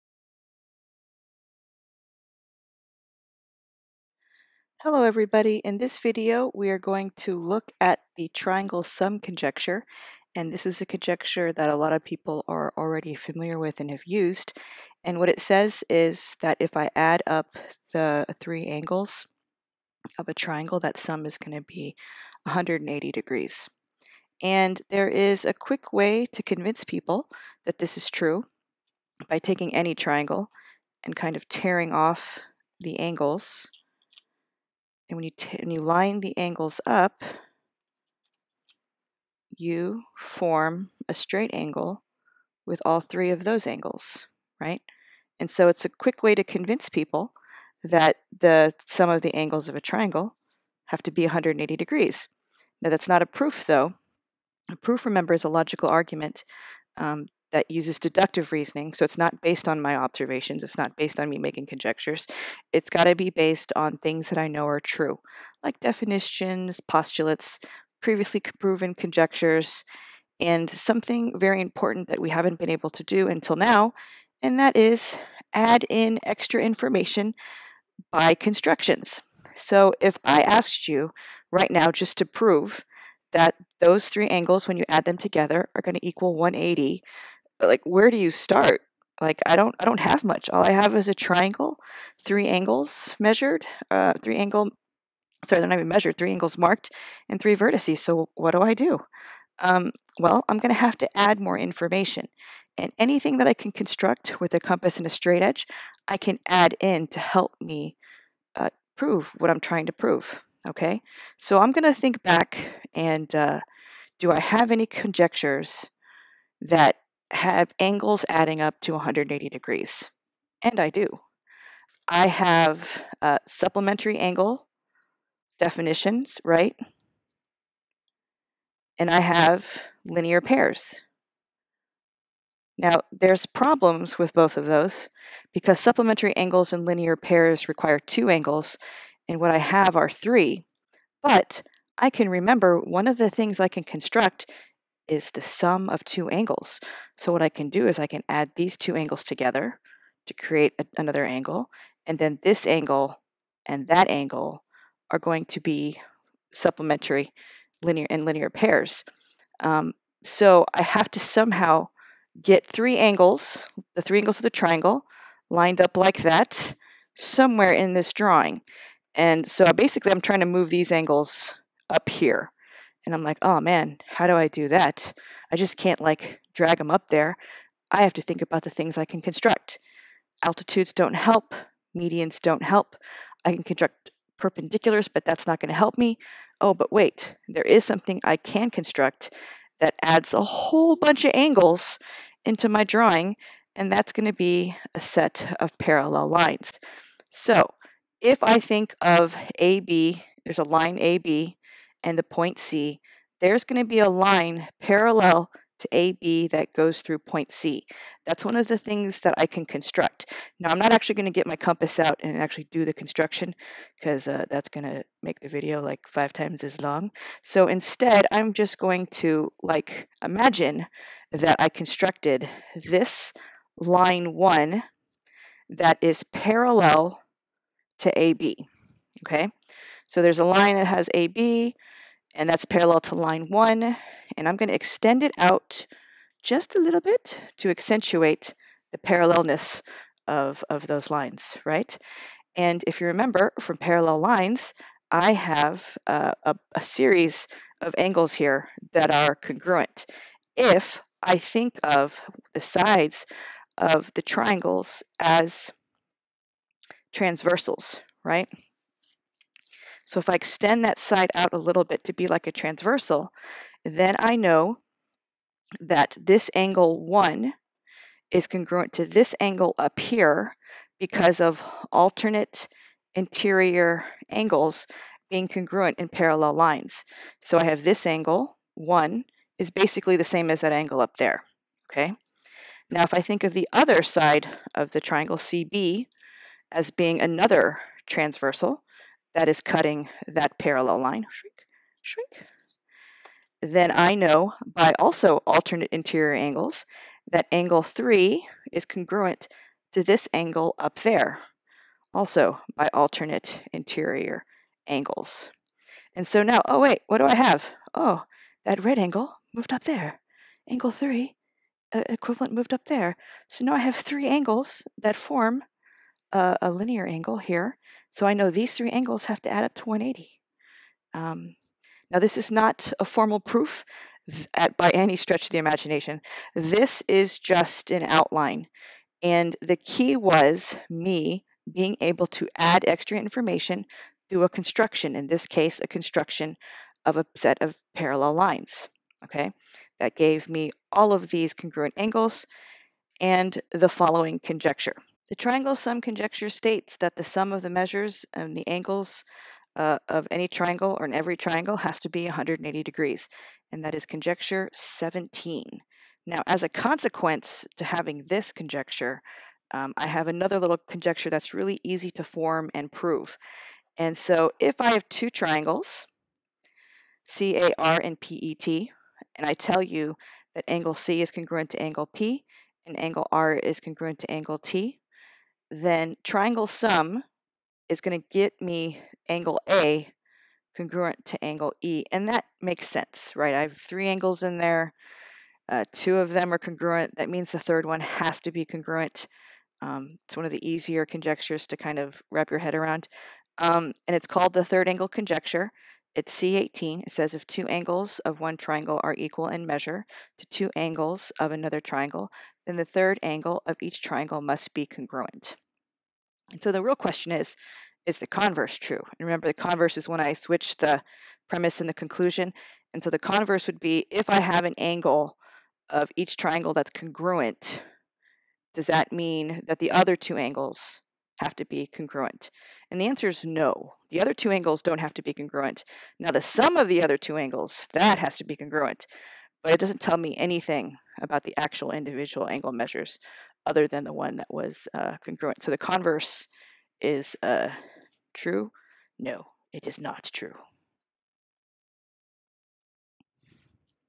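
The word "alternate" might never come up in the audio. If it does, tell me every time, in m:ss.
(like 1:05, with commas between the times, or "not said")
4:31, 4:55, 5:02.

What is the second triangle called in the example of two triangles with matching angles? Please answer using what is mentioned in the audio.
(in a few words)
PET.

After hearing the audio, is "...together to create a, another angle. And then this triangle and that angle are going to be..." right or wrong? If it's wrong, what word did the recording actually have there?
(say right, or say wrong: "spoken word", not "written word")
wrong: "angle", not "triangle".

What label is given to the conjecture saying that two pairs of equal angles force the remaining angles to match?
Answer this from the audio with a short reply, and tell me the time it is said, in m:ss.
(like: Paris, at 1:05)
C18, at 6:36.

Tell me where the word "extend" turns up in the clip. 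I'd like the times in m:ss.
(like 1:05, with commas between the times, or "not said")
3:54, 4:20.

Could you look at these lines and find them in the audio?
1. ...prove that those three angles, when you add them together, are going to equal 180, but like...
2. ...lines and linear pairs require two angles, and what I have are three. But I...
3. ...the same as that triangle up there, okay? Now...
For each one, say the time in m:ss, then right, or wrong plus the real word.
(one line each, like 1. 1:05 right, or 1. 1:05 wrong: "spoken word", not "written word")
1. 1:22 right
2. 2:16 wrong: "angles", not "lines"
3. 4:40 wrong: "angle", not "triangle".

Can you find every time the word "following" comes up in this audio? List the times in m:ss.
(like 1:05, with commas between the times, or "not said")
5:43.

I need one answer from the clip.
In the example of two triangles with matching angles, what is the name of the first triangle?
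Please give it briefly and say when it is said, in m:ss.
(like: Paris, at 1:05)
CAR, at 6:07.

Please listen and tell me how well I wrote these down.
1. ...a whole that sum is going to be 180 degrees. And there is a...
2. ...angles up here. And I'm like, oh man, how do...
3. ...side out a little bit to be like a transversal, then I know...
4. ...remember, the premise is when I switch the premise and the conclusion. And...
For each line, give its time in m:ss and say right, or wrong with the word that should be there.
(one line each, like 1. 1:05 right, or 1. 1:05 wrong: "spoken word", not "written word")
1. 0:20 wrong: "triangle", not "whole"
2. 2:50 right
3. 4:20 right
4. 6:49 wrong: "converse", not "premise".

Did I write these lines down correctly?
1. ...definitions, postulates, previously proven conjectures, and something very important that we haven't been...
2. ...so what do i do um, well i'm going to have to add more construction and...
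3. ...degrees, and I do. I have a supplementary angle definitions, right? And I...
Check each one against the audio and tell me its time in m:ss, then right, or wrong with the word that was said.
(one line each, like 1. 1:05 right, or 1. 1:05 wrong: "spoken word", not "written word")
1. 1:05 right
2. 1:37 wrong: "information", not "construction"
3. 1:59 right.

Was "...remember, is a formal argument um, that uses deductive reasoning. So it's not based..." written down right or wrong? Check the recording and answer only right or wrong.
wrong.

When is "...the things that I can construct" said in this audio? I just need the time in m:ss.
3:28.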